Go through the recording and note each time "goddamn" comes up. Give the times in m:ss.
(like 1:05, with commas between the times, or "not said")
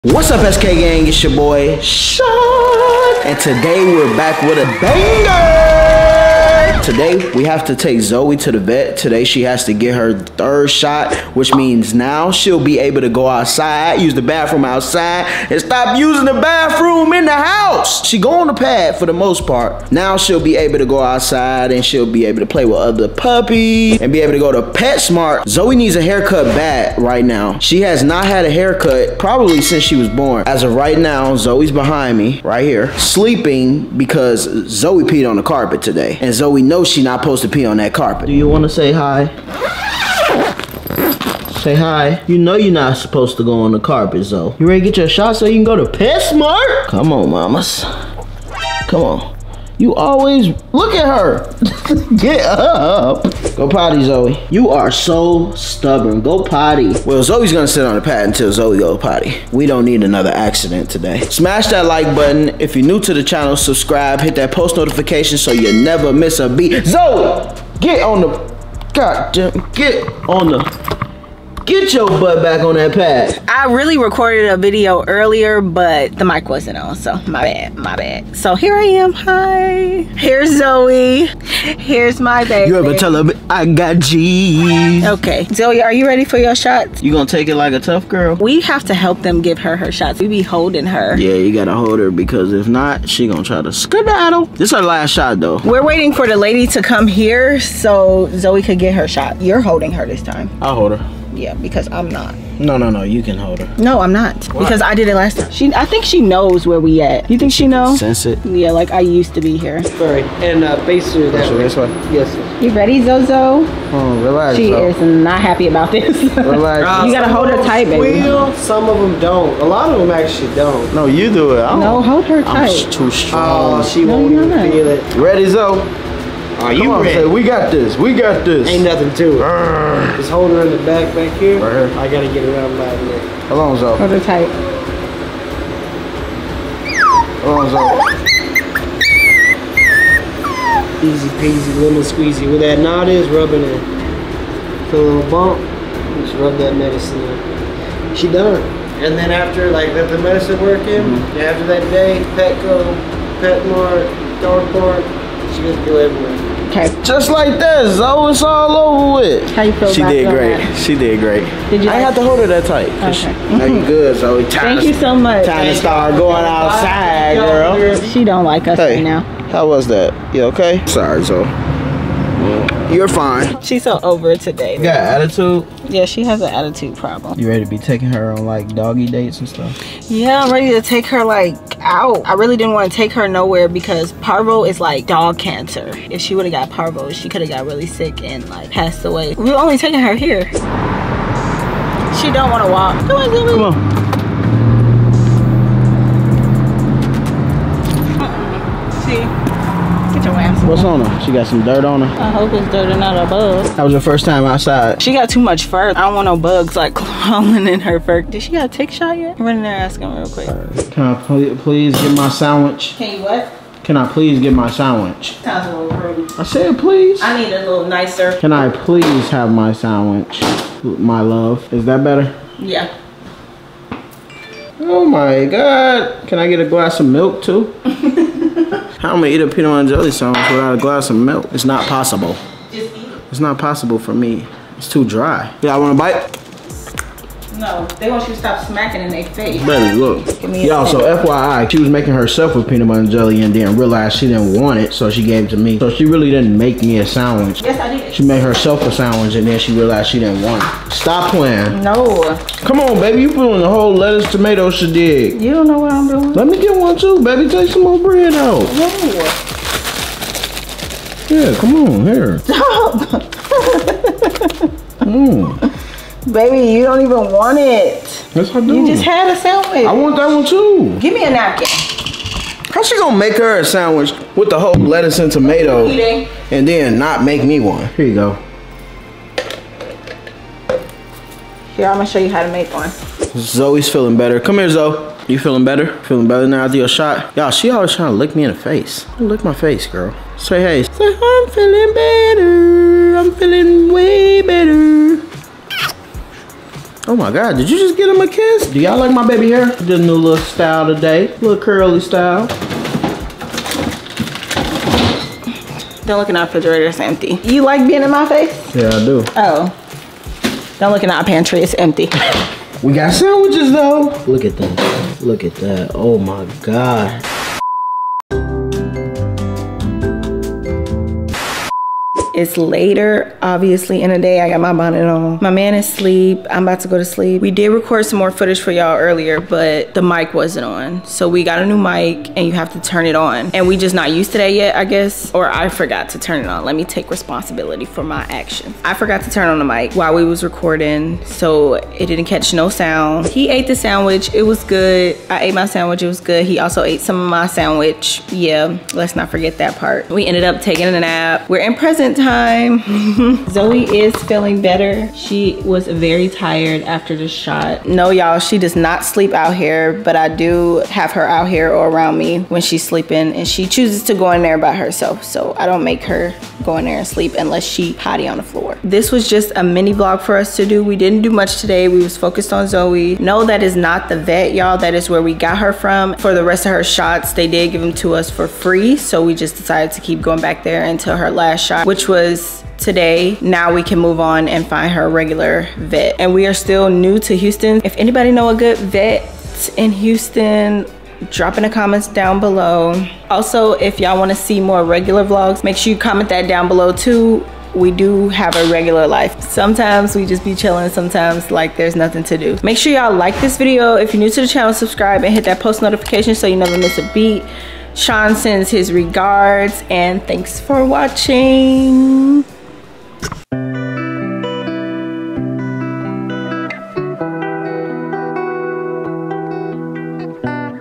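1:08.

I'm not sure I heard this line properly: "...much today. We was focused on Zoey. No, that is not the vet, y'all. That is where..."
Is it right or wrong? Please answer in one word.
right.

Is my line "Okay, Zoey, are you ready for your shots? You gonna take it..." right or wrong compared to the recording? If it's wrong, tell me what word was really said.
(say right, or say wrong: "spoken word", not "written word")
right.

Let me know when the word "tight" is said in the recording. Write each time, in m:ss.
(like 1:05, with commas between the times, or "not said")
1:57, 2:02, 2:14, 2:42.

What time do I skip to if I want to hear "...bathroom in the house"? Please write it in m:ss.
0:16.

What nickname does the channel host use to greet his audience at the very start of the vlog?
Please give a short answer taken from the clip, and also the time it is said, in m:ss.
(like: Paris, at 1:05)
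SK Gang, at 0:00.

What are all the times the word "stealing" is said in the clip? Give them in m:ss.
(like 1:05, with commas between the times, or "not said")
not said.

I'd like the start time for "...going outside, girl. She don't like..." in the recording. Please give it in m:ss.
2:46.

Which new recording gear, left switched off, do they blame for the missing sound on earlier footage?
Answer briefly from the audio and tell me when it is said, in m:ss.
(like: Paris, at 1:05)
new mic, at 5:31.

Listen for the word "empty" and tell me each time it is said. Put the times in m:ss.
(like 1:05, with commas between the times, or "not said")
5:07, 5:11.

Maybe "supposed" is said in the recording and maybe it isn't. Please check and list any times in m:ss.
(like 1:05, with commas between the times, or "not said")
0:37, 0:42.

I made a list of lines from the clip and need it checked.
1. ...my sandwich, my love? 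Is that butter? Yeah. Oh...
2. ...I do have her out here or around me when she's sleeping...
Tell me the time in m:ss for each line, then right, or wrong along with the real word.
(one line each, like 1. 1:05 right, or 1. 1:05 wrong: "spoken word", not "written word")
1. 3:39 wrong: "better", not "butter"
2. 6:00 right.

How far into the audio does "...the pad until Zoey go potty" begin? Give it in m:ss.
0:57.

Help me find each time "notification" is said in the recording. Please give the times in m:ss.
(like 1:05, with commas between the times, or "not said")
1:04, 6:45.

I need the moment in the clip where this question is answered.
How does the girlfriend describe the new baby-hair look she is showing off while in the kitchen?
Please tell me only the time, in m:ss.
5:01.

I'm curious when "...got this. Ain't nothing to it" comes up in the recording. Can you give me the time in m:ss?
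2:08.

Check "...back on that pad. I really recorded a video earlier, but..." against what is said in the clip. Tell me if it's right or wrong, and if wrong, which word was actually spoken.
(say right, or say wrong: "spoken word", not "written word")
right.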